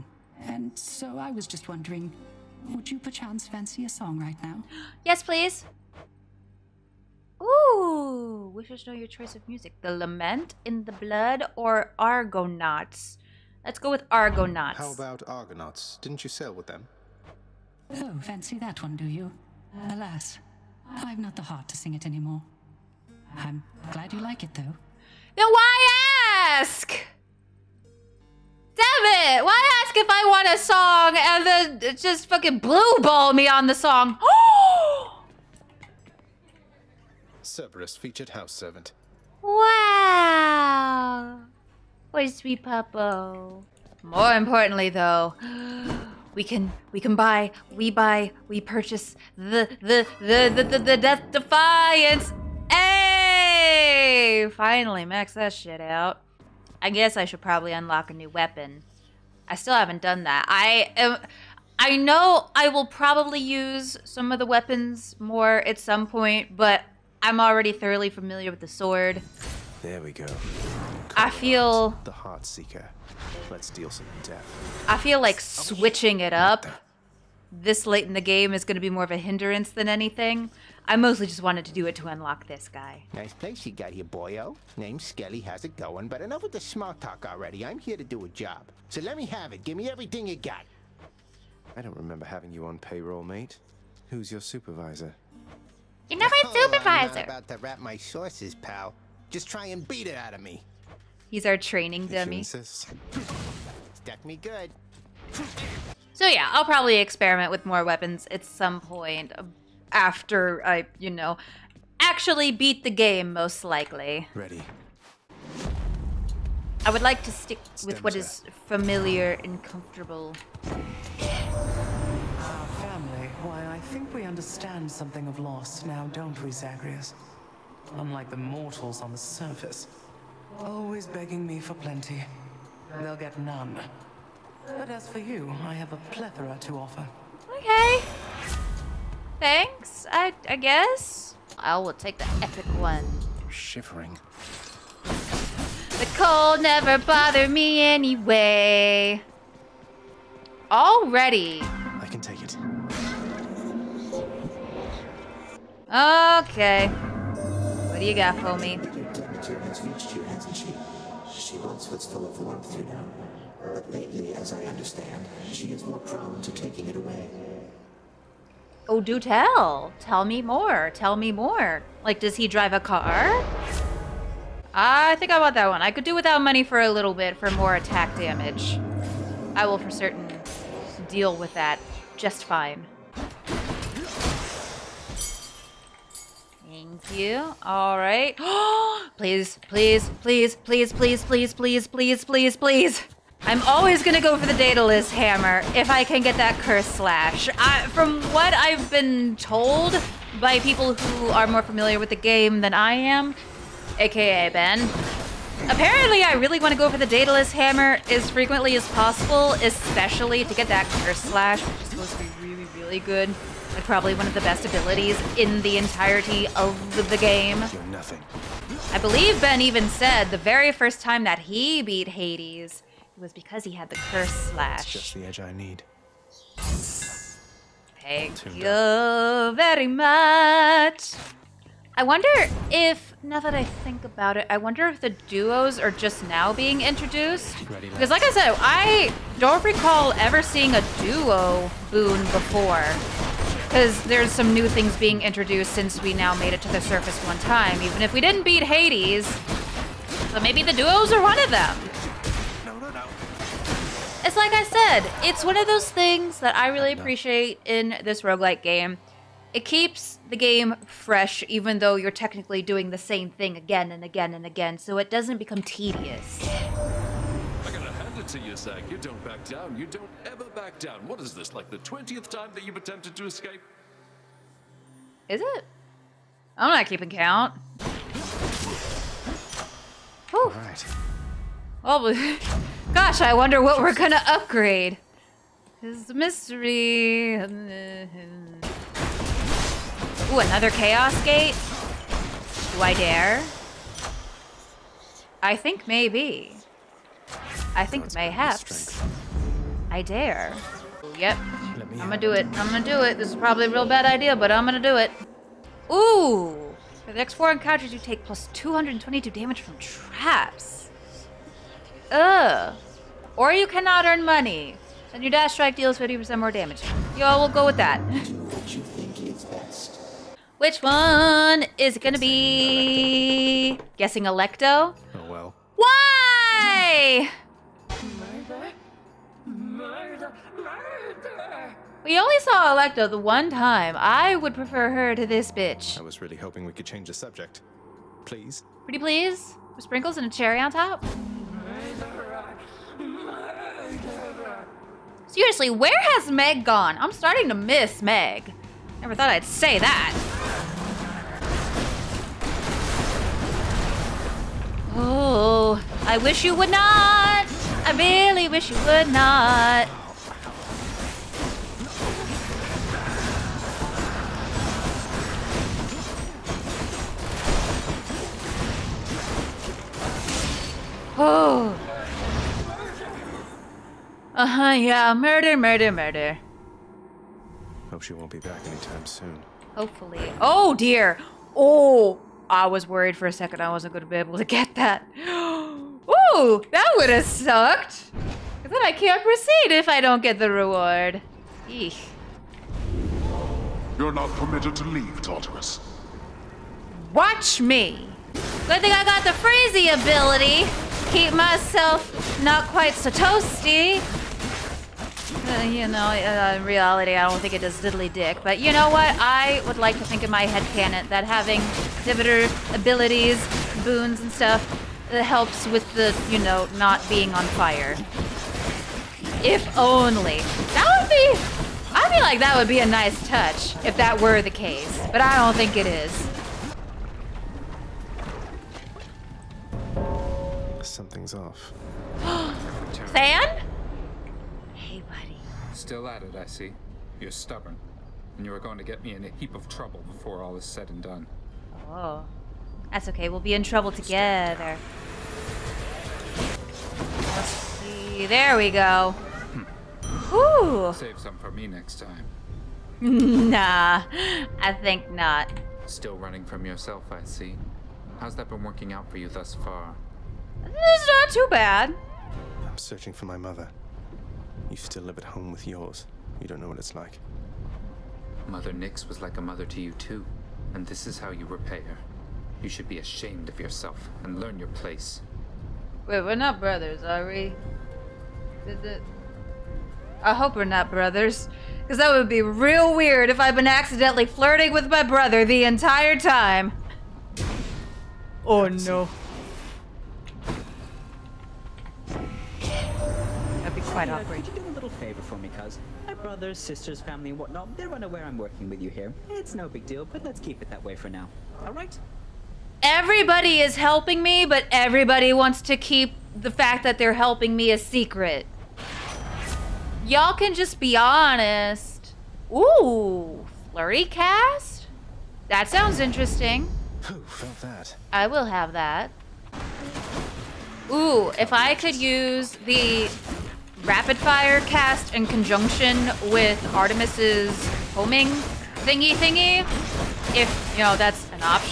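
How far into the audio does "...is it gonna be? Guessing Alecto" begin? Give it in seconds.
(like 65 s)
321 s.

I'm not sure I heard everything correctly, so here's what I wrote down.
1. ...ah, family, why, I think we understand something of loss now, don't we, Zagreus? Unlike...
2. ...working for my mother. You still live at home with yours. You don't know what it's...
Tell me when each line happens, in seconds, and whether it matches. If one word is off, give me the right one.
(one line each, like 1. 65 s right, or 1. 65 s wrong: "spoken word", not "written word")
1. 122 s right
2. 462 s wrong: "searching", not "working".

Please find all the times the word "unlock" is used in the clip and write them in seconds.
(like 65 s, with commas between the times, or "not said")
57 s, 82 s.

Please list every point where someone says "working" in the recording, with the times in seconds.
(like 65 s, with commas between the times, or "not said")
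458 s, 498 s.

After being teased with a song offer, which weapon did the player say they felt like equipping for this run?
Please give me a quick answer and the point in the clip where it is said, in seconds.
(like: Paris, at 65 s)
Heart Seeker, at 72 s.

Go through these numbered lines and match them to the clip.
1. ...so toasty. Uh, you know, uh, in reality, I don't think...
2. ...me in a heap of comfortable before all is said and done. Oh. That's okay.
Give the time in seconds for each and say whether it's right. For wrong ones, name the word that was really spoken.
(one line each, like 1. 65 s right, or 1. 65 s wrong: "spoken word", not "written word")
1. 402 s right
2. 439 s wrong: "trouble", not "comfortable".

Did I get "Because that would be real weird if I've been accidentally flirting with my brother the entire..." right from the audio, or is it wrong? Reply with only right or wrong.
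right.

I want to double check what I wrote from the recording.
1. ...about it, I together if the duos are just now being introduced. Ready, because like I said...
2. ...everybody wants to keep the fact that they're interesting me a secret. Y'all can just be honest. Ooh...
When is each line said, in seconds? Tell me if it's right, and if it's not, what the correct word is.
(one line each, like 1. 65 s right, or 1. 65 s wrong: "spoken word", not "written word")
1. 234 s wrong: "wonder", not "together"
2. 504 s wrong: "helping", not "interesting".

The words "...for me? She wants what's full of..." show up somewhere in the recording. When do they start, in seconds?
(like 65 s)
158 s.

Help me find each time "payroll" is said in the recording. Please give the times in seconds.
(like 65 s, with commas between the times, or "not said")
92 s.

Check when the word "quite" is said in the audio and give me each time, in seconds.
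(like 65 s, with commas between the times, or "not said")
402 s, 493 s.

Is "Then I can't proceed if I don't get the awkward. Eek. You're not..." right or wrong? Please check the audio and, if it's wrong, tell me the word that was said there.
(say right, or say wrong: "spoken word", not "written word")
wrong: "reward", not "awkward".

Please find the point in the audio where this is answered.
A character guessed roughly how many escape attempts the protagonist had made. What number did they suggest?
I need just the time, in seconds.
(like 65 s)
271 s.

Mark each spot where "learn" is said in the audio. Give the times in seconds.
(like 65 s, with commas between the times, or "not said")
474 s.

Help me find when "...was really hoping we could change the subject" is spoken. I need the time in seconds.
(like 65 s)
336 s.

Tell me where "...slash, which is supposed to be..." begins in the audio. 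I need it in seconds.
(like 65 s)
211 s.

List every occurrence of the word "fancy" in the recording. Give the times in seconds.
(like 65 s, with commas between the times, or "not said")
3 s, 18 s.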